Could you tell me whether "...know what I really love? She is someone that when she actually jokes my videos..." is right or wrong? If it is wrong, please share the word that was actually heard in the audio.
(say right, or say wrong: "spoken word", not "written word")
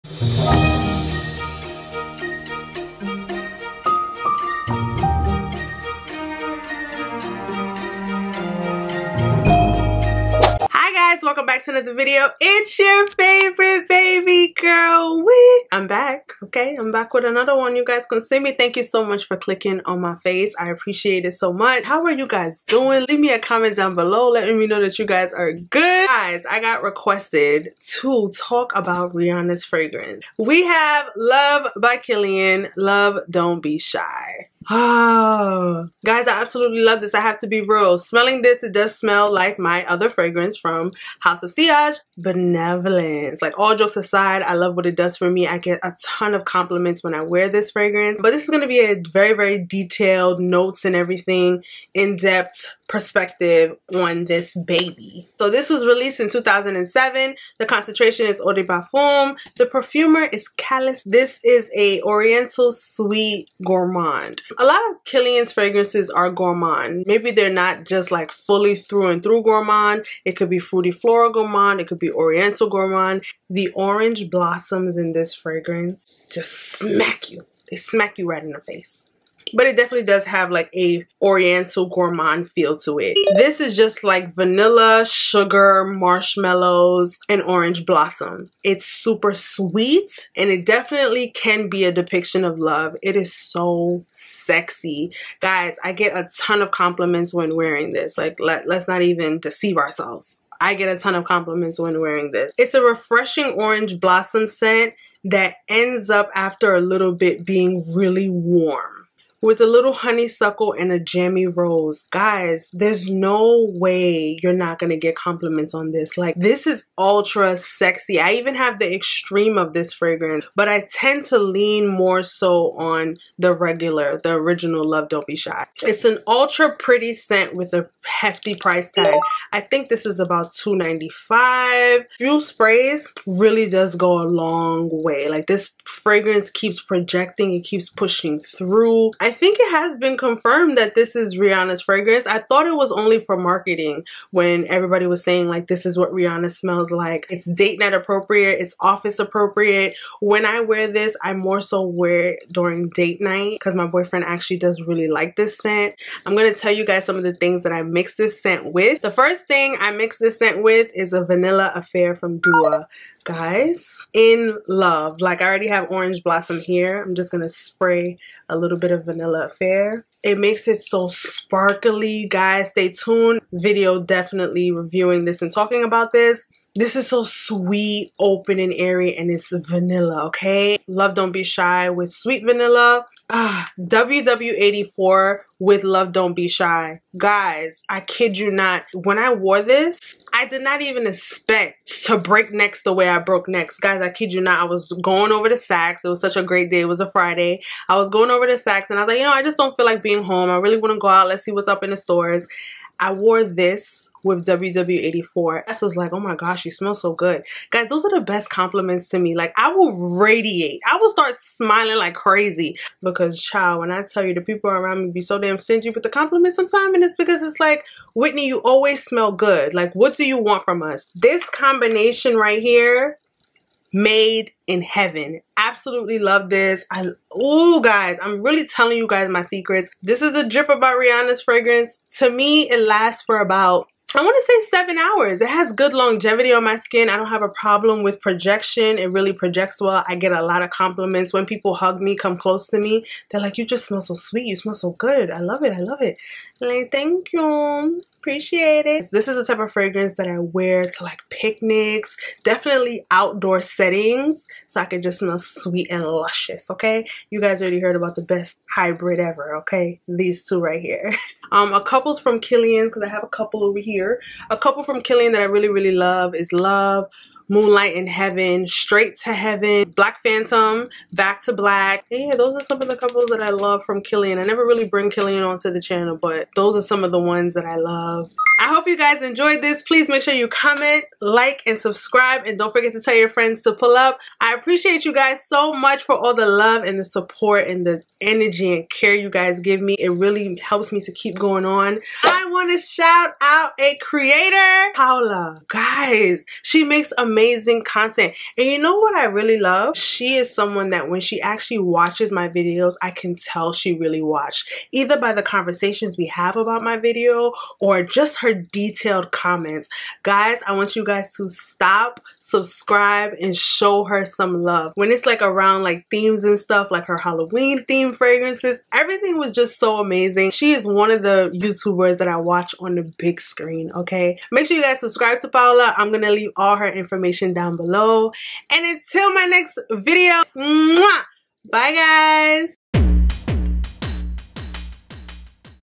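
wrong: "watches", not "jokes".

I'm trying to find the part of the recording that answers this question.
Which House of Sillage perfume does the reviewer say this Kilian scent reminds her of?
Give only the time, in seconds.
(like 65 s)
42 s.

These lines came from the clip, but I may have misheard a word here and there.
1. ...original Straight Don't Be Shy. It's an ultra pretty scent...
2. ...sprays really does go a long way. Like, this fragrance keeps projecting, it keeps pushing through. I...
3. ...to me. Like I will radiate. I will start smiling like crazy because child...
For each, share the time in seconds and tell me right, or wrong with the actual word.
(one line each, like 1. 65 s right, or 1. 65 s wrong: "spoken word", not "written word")
1. 124 s wrong: "Love", not "Straight"
2. 132 s right
3. 209 s right.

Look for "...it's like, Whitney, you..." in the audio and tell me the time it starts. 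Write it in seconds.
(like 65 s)
217 s.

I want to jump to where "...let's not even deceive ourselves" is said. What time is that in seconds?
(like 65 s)
98 s.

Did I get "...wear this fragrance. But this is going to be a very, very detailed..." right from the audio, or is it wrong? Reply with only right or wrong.
right.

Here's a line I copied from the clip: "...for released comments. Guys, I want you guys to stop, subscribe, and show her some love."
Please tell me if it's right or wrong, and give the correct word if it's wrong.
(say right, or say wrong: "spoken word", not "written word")
wrong: "detailed", not "released".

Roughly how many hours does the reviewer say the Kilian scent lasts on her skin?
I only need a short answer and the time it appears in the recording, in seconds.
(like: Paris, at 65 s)
7, at 234 s.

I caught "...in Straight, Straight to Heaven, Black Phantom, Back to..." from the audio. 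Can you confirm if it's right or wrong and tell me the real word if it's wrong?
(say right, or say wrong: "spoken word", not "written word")
wrong: "Heaven", not "Straight".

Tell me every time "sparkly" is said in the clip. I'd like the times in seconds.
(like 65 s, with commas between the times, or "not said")
171 s.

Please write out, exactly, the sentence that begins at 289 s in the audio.
It really helps me to keep going on.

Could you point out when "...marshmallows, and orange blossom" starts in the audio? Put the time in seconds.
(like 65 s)
85 s.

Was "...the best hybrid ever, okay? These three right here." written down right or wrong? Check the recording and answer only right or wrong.
wrong.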